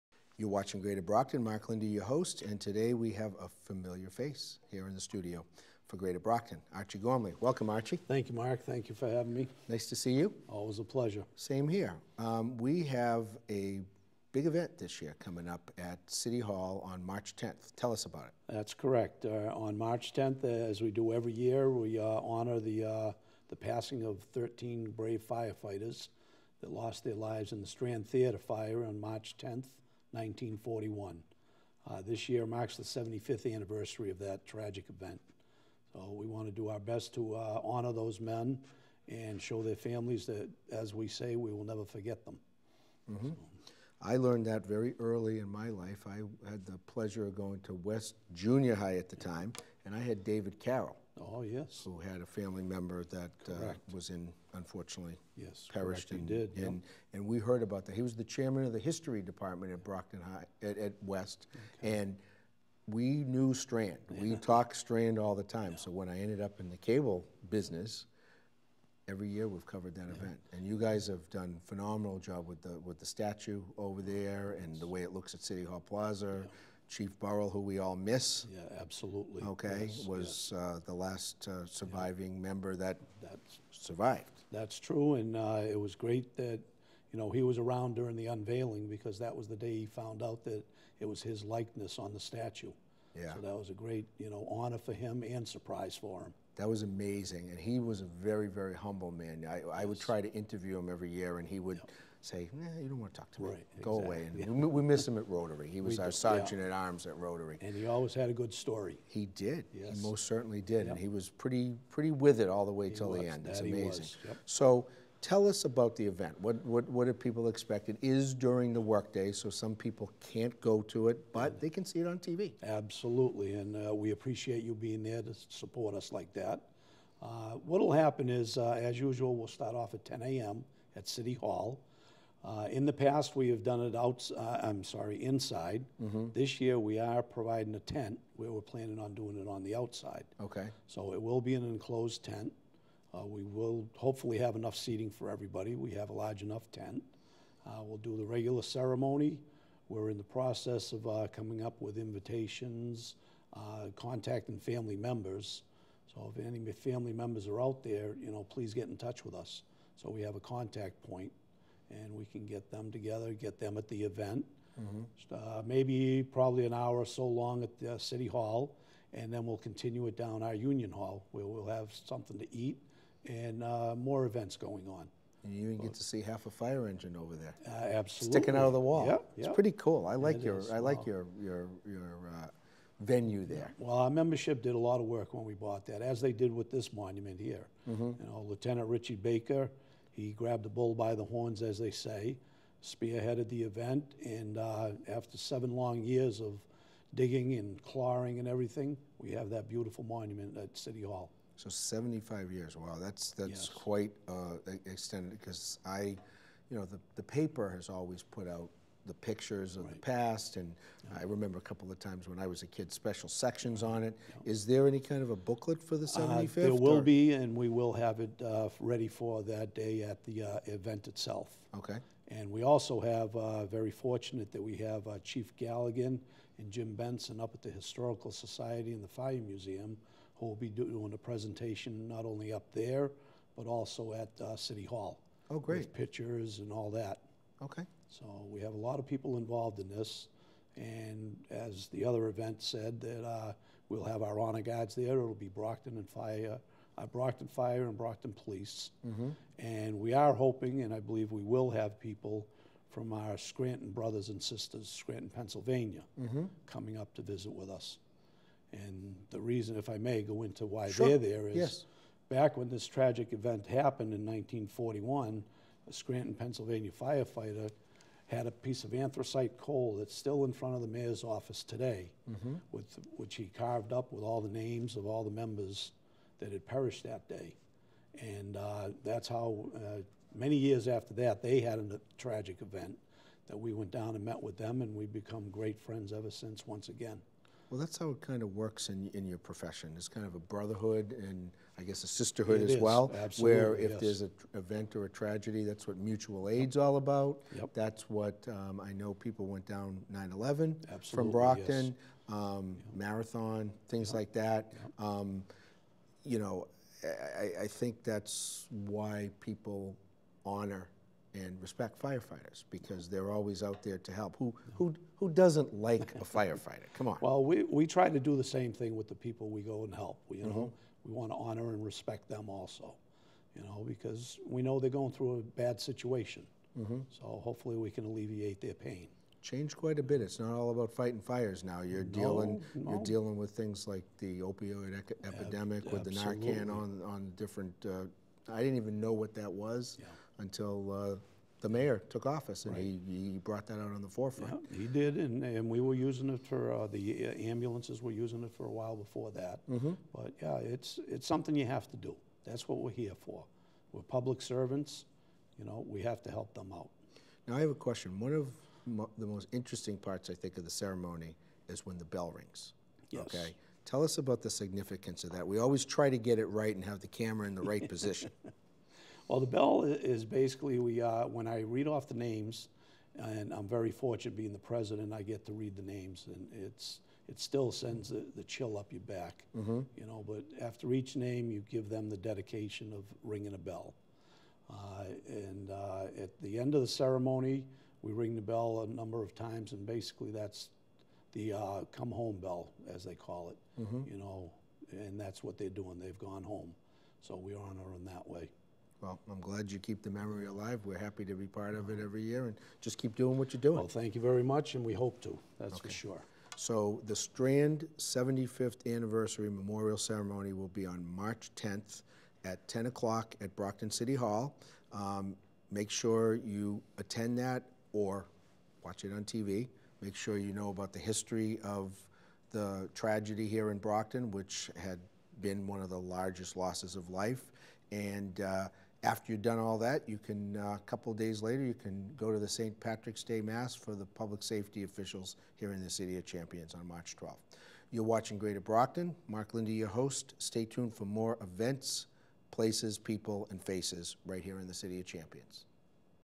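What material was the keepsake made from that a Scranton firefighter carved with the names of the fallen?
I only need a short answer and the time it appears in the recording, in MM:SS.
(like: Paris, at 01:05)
anthracite coal, at 04:28.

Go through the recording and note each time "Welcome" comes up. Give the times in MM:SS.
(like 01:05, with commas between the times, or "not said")
00:07.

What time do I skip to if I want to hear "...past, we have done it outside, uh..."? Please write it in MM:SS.
02:12.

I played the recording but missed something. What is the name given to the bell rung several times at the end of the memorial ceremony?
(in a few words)
come home bell.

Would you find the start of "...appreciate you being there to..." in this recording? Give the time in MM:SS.
02:04.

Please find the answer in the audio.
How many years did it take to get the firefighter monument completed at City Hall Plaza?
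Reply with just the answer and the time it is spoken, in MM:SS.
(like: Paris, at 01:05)
7, at 03:15.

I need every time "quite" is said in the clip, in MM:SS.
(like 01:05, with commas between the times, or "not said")
03:23, 05:29.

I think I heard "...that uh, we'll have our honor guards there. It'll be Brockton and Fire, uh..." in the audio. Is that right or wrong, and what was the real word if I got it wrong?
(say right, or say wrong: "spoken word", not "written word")
right.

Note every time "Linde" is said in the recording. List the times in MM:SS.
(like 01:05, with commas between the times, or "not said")
00:01, 07:19.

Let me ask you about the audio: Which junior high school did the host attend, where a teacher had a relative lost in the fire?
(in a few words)
West Junior High.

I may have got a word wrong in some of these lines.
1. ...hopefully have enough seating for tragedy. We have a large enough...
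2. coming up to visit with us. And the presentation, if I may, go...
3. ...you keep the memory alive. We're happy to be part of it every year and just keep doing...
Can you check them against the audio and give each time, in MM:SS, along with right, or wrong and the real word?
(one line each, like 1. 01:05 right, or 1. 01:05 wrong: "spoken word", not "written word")
1. 02:23 wrong: "everybody", not "tragedy"
2. 04:16 wrong: "reason", not "presentation"
3. 06:39 right.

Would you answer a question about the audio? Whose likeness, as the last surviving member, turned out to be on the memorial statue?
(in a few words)
Chief Burrell.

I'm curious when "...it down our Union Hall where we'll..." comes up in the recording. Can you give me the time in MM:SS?
02:50.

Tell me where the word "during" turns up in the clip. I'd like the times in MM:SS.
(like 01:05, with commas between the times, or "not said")
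01:27, 01:58.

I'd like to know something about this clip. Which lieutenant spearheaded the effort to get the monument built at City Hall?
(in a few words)
Richie Baker.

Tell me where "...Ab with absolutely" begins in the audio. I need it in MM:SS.
05:35.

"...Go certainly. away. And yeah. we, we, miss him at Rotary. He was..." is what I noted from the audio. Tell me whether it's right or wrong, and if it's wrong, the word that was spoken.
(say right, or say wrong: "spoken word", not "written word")
wrong: "exactly", not "certainly".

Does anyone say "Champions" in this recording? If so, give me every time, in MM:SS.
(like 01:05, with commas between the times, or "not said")
07:16, 07:25.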